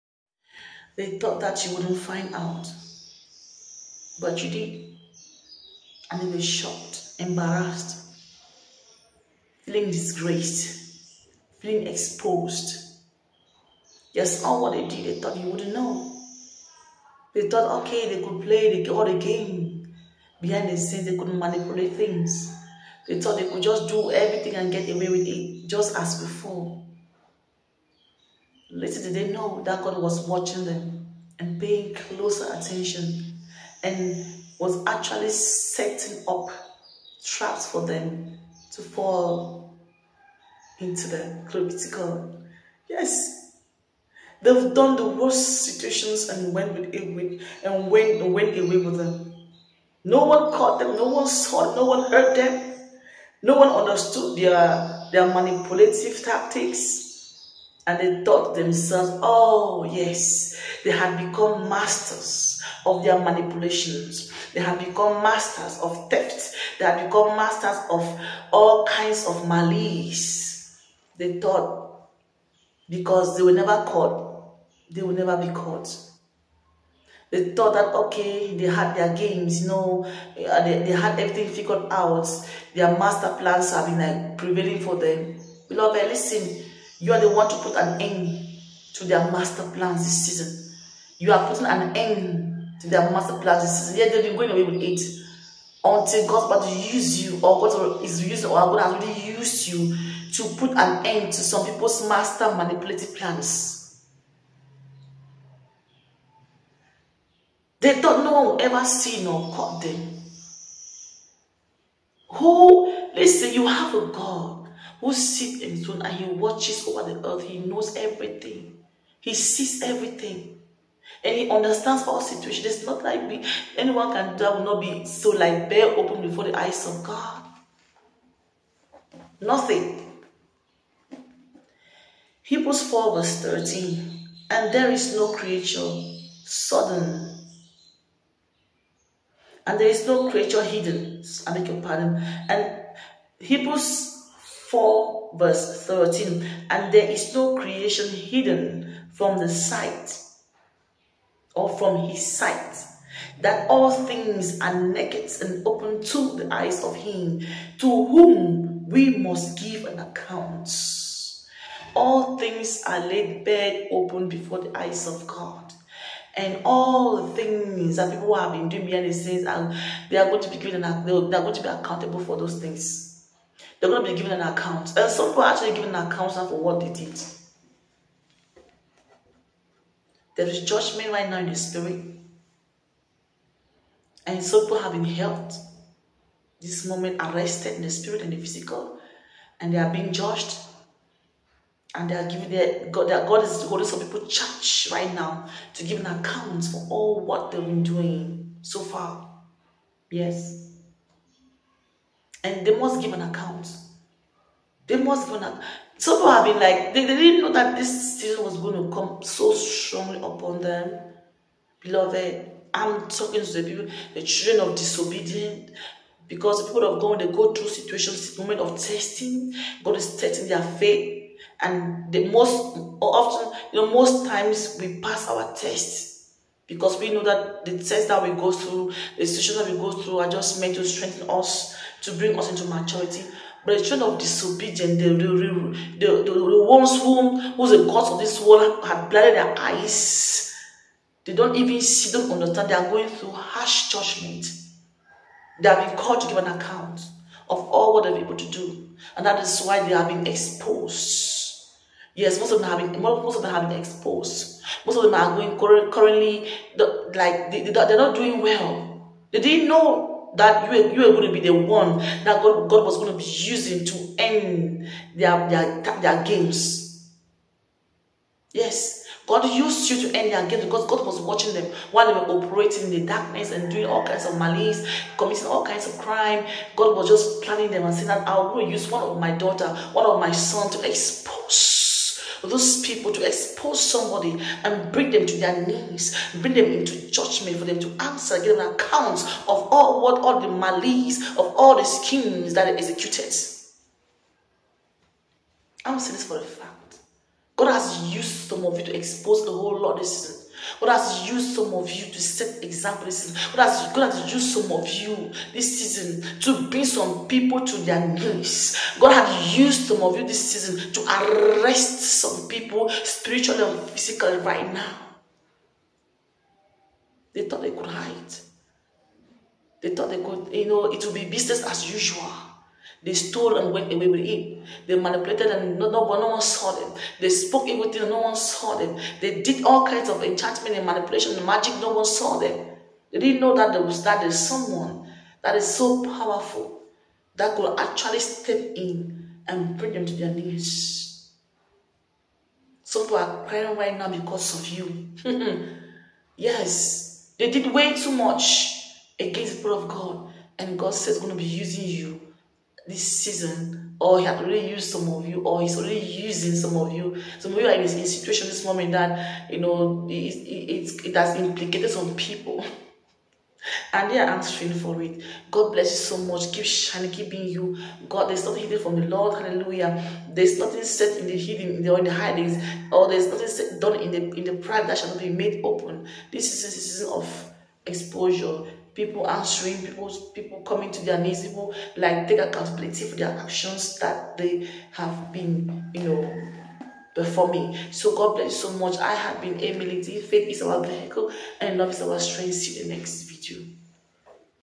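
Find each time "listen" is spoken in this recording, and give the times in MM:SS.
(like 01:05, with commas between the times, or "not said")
01:26, 01:53.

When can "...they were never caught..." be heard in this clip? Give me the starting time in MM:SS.
01:13.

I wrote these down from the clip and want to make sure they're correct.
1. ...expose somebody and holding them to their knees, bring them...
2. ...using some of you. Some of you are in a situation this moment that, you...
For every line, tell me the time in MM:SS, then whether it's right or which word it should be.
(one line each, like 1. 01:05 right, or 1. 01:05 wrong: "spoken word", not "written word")
1. 04:43 wrong: "bring", not "holding"
2. 05:55 right.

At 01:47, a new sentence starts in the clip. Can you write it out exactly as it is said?
They thought no one will ever see nor caught them.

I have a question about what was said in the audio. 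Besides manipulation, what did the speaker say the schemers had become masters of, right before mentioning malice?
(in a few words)
Theft.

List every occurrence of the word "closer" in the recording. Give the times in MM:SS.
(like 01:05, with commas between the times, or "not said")
00:31.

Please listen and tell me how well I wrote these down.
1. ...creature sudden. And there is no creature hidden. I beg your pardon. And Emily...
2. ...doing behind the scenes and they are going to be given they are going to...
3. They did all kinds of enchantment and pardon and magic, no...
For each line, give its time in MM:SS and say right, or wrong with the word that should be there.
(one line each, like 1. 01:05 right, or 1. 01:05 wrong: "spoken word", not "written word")
1. 02:15 wrong: "Hebrews", not "Emily"
2. 02:48 right
3. 05:29 wrong: "manipulation", not "pardon".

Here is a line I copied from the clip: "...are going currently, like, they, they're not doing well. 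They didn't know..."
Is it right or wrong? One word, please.
right.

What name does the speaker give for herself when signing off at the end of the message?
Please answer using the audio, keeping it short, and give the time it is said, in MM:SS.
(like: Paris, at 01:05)
Emily D, at 06:29.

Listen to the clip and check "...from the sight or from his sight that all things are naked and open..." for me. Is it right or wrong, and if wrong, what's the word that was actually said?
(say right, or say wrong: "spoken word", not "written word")
right.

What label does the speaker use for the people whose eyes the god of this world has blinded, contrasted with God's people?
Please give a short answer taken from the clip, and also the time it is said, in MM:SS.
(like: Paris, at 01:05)
Children of disobedience, at 03:53.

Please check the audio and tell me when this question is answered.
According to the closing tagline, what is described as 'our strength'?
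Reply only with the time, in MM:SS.
06:31.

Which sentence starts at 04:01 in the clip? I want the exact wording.
They don't even see, don't understand.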